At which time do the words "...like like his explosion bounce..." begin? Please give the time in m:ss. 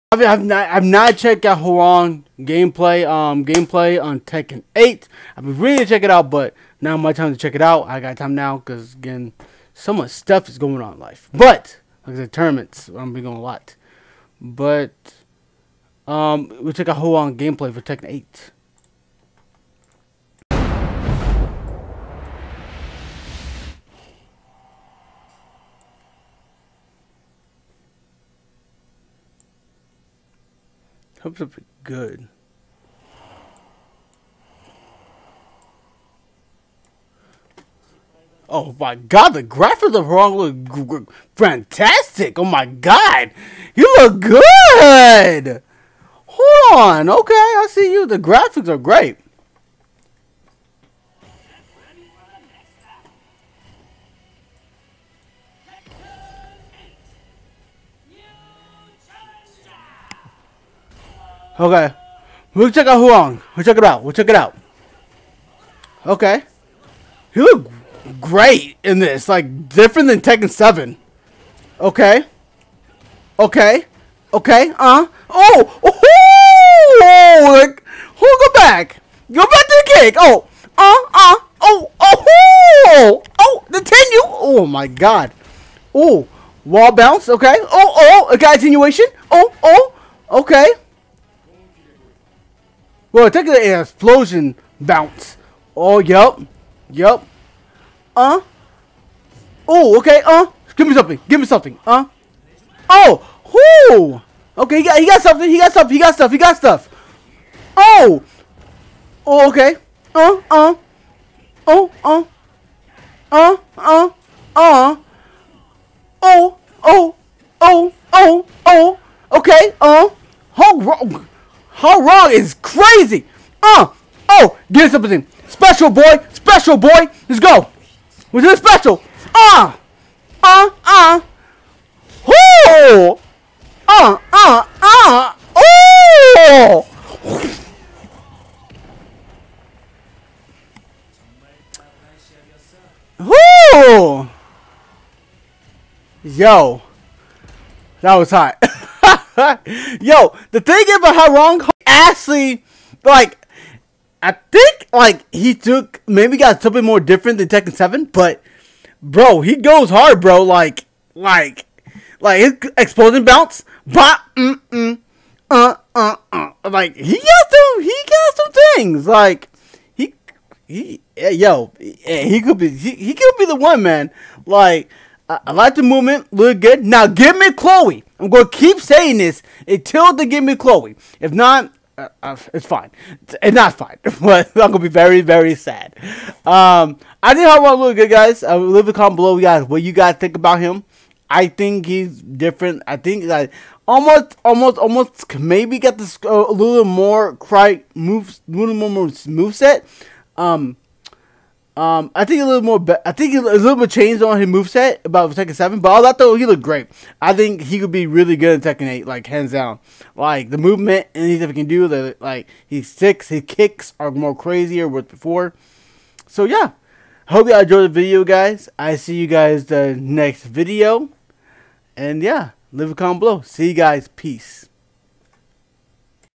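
2:41.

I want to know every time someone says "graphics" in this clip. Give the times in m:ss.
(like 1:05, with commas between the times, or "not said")
0:39, 0:48.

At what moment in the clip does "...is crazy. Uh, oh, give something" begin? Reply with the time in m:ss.
2:02.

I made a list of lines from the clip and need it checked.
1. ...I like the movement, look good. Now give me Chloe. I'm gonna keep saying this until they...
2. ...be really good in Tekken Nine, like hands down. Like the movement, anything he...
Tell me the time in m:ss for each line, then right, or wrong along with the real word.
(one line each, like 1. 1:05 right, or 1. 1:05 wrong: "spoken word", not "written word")
1. 2:55 right
2. 3:27 wrong: "Eight", not "Nine".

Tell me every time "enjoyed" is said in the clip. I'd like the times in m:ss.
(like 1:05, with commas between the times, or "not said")
3:37.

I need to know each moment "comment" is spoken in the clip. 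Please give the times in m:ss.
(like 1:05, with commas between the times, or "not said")
3:08, 3:42.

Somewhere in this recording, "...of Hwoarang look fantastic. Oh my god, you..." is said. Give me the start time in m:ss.
0:39.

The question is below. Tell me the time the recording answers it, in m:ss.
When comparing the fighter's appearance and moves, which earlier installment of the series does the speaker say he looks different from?
1:10.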